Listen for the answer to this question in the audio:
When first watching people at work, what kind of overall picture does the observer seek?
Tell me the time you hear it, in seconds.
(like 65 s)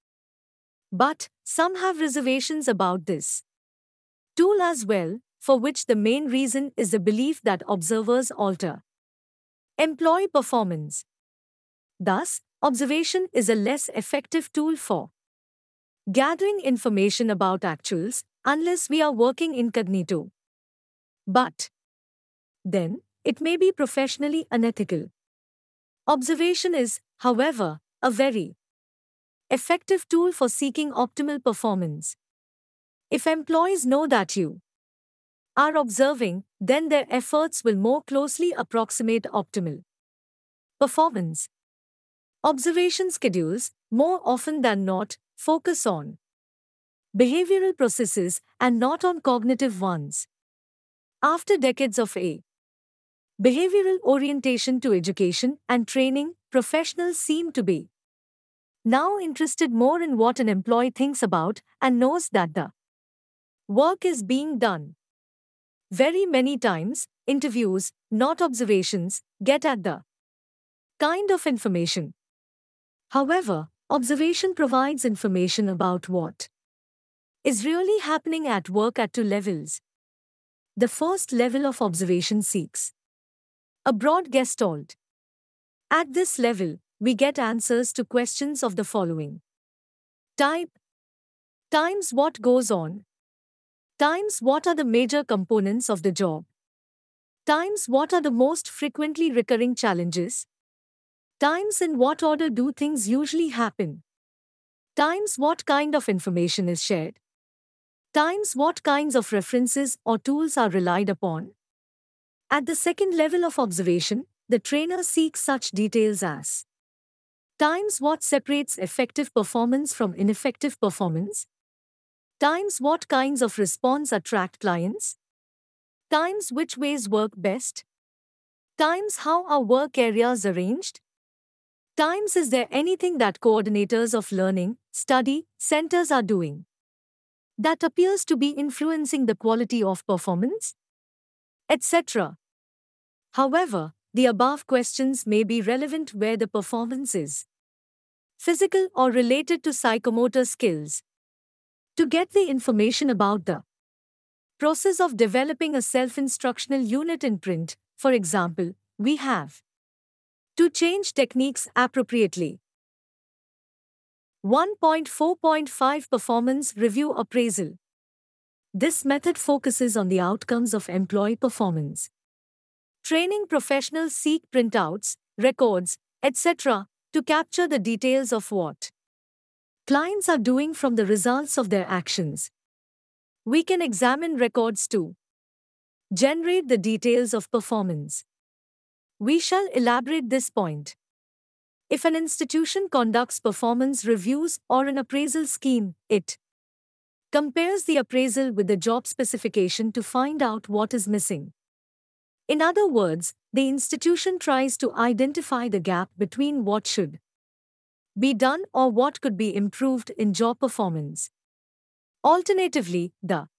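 83 s.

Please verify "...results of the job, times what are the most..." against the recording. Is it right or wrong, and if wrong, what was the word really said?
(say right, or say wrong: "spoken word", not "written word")
wrong: "components", not "results".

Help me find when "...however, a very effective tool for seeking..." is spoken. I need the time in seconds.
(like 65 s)
27 s.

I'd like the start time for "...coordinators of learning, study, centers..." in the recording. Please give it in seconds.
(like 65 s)
133 s.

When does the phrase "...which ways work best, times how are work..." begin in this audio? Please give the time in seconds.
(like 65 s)
126 s.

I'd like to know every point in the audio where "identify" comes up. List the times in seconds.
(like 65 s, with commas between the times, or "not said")
204 s.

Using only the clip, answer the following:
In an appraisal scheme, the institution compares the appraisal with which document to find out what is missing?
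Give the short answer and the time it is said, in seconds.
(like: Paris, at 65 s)
The job specification, at 198 s.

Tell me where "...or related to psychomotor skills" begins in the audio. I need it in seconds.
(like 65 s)
148 s.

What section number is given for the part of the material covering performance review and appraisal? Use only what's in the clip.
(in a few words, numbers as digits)
1.4.5.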